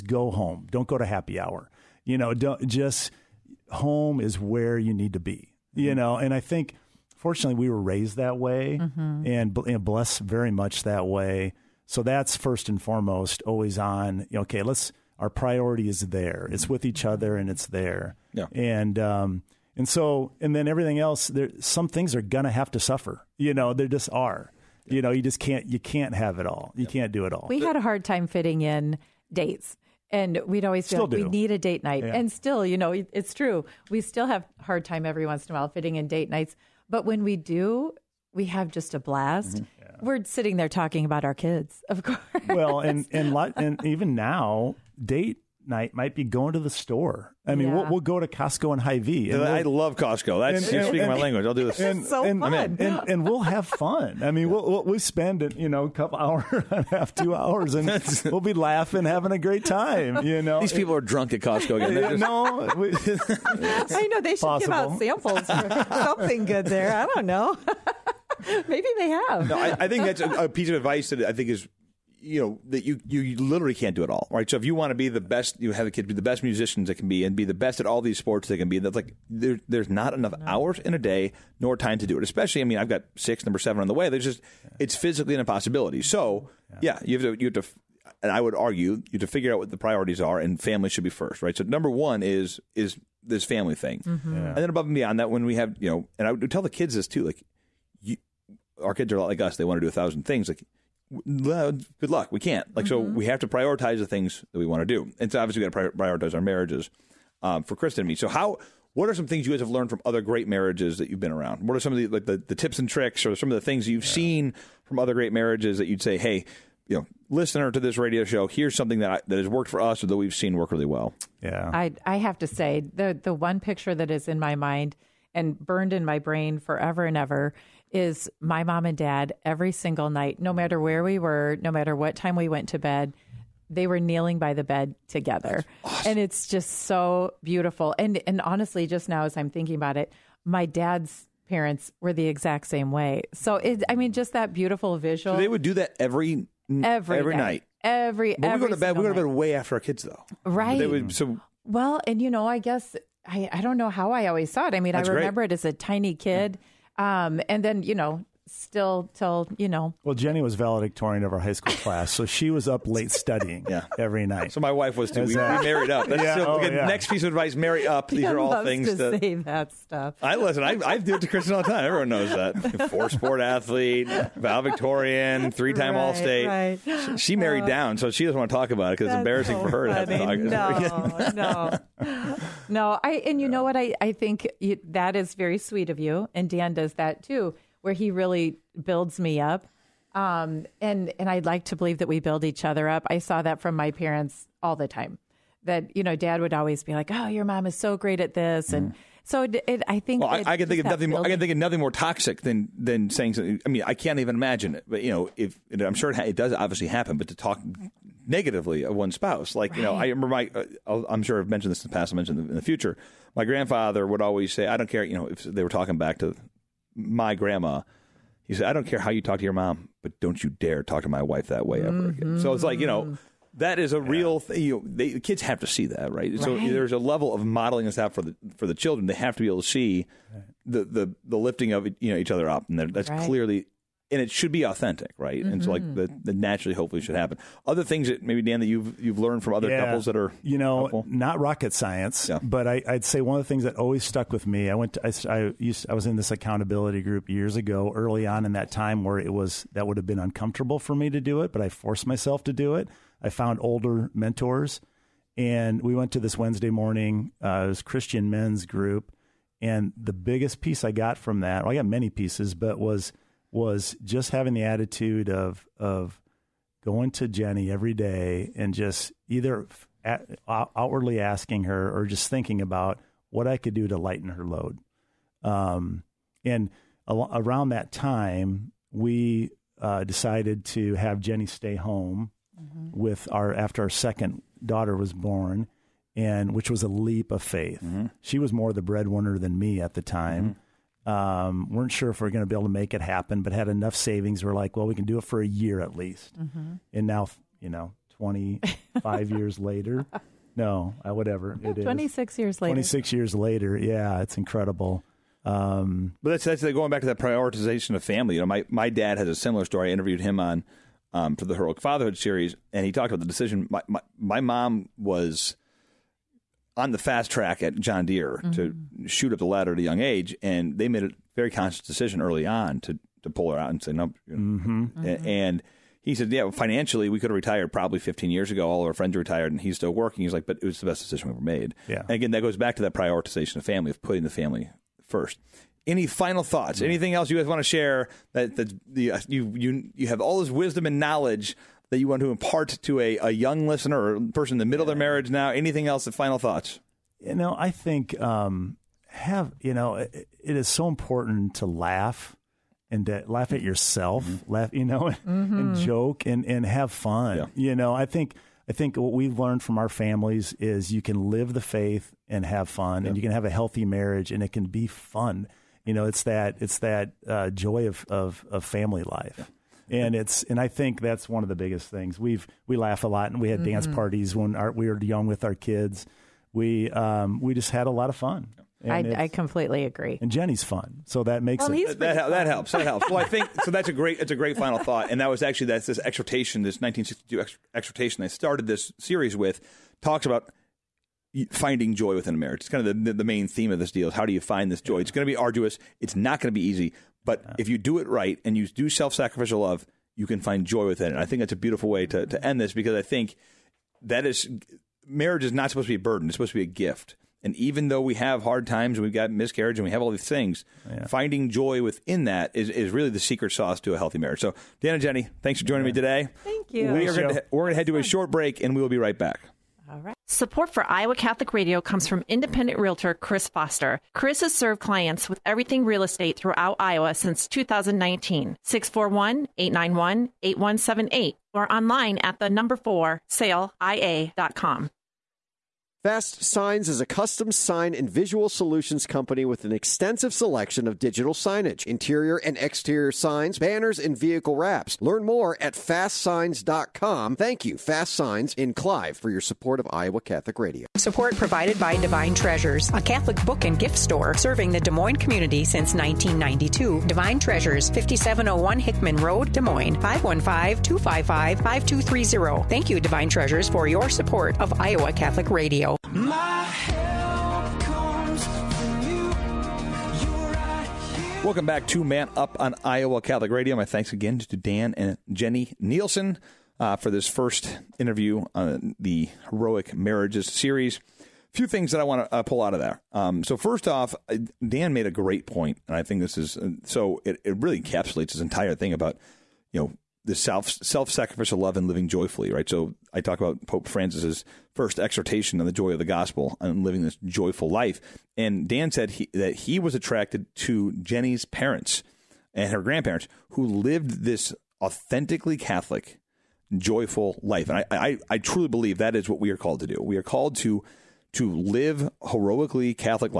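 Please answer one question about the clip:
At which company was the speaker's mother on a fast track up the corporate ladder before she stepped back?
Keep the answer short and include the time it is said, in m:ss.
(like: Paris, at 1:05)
John Deere, at 5:17.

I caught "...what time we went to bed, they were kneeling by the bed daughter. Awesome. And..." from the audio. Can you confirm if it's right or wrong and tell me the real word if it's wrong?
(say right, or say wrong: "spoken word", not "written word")
wrong: "together", not "daughter".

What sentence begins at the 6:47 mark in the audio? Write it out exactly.
And even though we have hard times and we've got miscarriage and we have all these things, yeah.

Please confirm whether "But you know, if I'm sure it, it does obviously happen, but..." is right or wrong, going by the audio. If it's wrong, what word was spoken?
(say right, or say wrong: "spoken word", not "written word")
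right.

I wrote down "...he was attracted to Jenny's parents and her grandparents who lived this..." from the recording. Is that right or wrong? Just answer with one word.
right.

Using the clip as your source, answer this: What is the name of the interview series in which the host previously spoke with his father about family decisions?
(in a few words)
Heroic Fatherhood.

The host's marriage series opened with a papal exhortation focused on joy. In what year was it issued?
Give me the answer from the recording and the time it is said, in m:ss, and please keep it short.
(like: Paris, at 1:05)
1962, at 6:26.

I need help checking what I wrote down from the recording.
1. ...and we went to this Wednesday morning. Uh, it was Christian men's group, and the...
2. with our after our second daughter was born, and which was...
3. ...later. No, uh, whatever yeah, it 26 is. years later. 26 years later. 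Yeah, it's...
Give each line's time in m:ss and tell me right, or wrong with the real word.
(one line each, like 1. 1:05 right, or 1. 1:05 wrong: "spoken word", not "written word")
1. 4:15 right
2. 4:42 right
3. 4:59 right.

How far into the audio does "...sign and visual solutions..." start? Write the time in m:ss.
7:17.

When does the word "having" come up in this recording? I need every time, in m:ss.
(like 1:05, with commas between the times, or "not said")
0:59, 4:24.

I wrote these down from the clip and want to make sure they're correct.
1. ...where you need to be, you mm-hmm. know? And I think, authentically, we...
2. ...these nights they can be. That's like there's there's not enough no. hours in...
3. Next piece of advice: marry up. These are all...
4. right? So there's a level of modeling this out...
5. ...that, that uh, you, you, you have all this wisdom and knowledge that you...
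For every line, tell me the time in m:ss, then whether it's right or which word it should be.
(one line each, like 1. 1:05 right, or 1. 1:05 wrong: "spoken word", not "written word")
1. 0:04 wrong: "fortunately", not "authentically"
2. 1:18 wrong: "sports", not "nights"
3. 2:46 right
4. 3:46 right
5. 5:38 right.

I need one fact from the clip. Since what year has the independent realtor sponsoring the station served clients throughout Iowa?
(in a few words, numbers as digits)
2019.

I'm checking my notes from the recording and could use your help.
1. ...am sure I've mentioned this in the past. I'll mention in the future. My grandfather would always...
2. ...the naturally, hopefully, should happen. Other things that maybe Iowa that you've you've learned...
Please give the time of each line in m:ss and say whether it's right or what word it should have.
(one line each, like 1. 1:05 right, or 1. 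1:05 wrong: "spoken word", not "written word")
1. 3:31 right
2. 3:56 wrong: "Dan", not "Iowa".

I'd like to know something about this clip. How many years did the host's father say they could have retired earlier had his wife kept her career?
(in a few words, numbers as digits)
15.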